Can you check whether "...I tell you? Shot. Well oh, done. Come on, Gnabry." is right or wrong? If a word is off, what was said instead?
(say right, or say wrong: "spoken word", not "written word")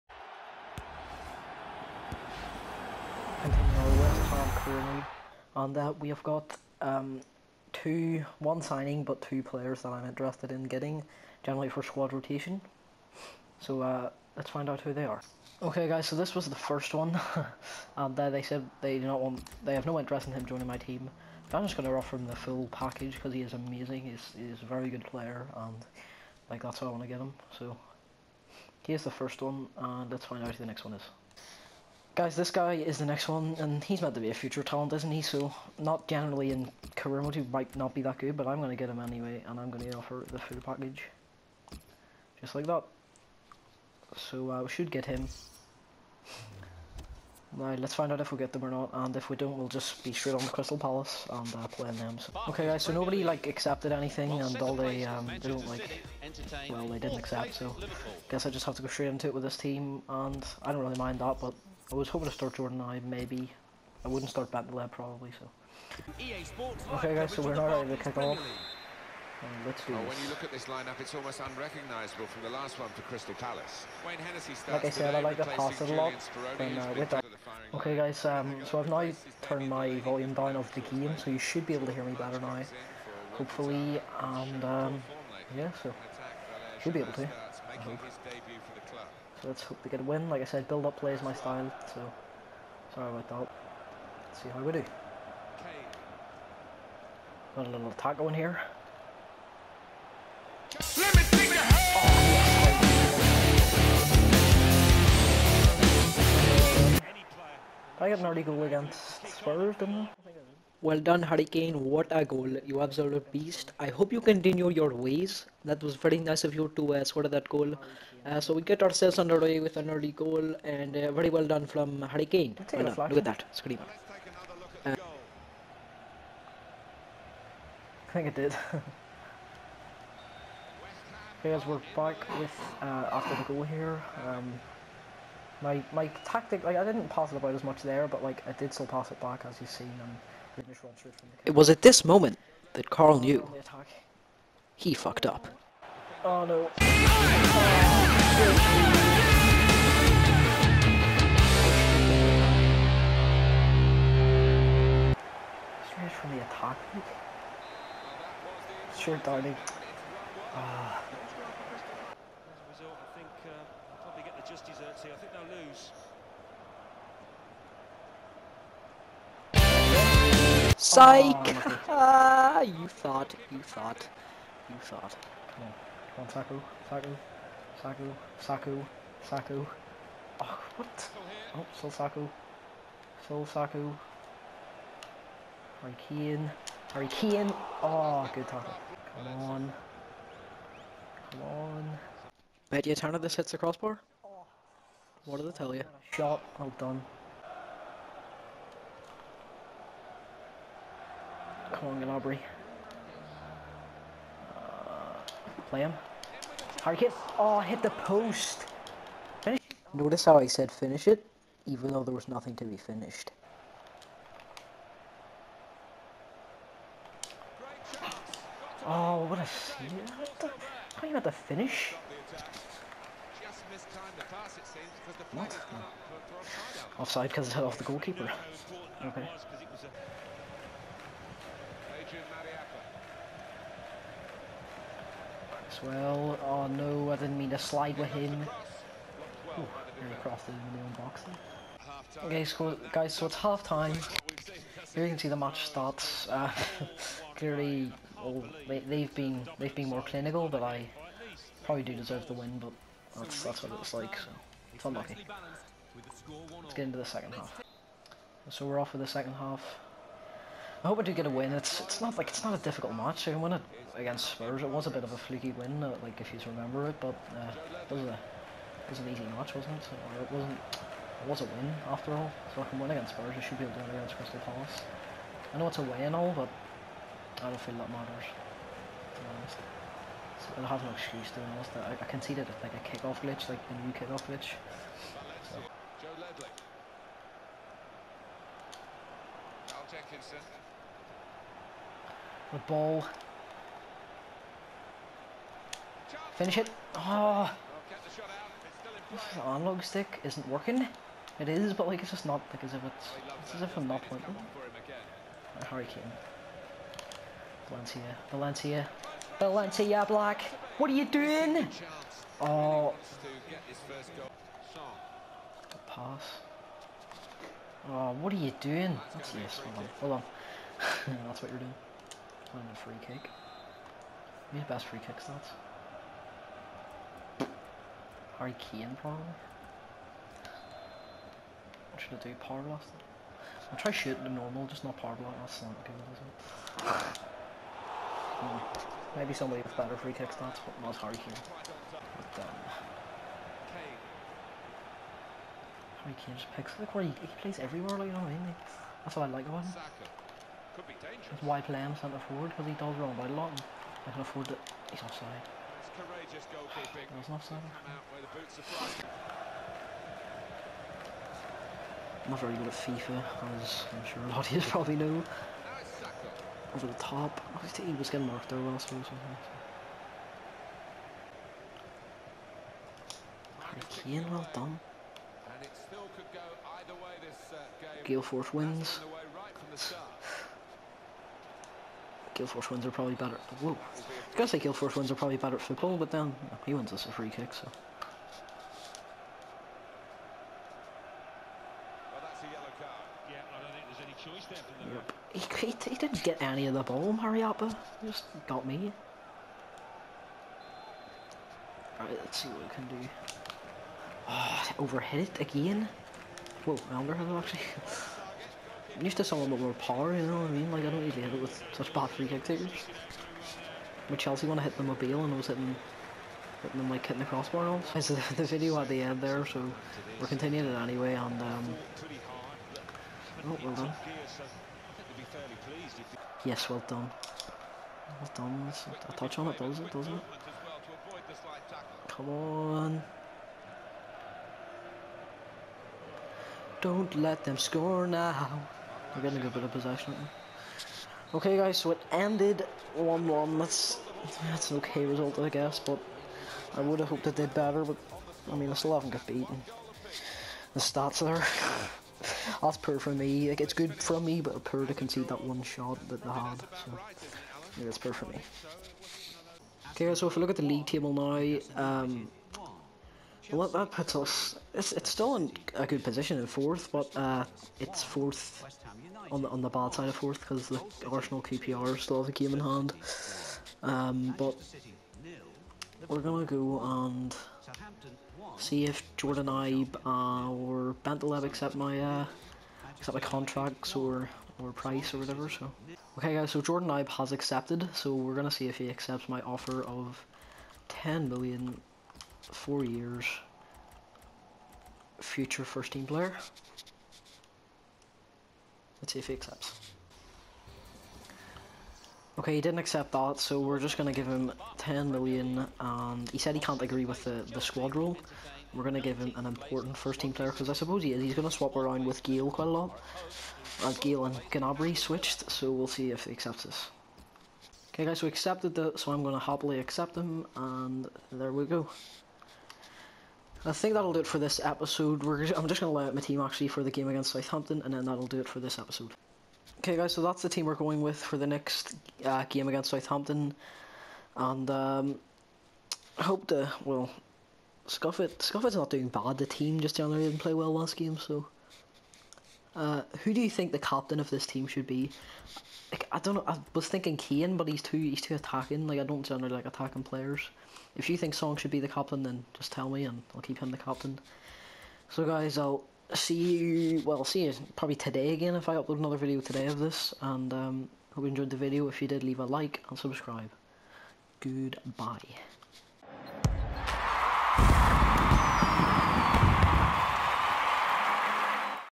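right.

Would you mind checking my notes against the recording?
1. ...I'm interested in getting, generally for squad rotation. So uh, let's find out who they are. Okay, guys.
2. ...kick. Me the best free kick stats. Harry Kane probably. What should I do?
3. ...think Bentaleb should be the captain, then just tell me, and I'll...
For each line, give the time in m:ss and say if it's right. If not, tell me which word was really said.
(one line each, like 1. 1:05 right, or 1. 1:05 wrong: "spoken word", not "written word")
1. 0:09 right
2. 5:23 right
3. 9:11 wrong: "Song", not "Bentaleb".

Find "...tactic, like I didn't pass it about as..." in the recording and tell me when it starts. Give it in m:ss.
2:16.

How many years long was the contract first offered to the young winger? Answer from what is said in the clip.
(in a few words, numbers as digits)
4.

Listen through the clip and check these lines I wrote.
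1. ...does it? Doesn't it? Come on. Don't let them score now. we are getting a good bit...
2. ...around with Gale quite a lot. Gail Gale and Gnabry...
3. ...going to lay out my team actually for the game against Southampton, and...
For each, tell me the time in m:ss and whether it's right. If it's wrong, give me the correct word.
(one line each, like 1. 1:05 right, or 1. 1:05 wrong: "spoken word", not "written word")
1. 7:09 right
2. 8:31 right
3. 8:45 right.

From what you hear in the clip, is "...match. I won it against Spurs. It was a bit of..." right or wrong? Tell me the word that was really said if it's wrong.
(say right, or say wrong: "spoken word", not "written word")
right.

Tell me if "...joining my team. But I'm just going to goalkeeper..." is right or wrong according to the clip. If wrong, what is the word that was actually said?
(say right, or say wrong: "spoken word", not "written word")
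wrong: "offer", not "goalkeeper".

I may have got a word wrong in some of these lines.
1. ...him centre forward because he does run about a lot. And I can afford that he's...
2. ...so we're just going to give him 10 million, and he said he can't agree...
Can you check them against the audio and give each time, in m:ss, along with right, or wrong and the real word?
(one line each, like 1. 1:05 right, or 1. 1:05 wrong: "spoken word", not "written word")
1. 5:51 right
2. 8:23 right.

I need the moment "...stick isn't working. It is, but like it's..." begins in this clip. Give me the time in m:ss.
4:59.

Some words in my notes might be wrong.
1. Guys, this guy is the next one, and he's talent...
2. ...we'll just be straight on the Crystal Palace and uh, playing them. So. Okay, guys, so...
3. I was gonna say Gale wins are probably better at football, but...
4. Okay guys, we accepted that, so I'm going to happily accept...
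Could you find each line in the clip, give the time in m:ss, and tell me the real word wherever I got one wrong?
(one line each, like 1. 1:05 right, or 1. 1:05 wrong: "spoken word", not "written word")
1. 0:32 wrong: "meant", not "talent"
2. 0:49 right
3. 6:23 right
4. 8:37 right.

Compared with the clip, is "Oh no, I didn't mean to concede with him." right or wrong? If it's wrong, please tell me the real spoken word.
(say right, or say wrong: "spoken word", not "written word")
wrong: "slide", not "concede".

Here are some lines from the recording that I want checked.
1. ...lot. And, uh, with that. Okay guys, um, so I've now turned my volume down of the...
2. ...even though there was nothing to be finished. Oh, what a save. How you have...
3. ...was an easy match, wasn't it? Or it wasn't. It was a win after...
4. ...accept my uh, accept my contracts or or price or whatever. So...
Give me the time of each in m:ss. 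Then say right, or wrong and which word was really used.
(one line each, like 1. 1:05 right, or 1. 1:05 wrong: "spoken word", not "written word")
1. 1:15 right
2. 3:31 right
3. 4:28 right
4. 8:01 right.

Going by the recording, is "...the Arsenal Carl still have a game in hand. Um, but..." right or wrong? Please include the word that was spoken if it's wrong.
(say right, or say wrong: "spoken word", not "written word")
wrong: "QPR", not "Carl".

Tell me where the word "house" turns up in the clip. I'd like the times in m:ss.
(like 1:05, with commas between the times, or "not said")
not said.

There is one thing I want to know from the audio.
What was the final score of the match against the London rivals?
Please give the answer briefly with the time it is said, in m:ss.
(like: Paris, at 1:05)
1-1, at 7:22.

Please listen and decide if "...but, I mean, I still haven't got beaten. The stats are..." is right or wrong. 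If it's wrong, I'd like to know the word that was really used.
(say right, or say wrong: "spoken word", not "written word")
right.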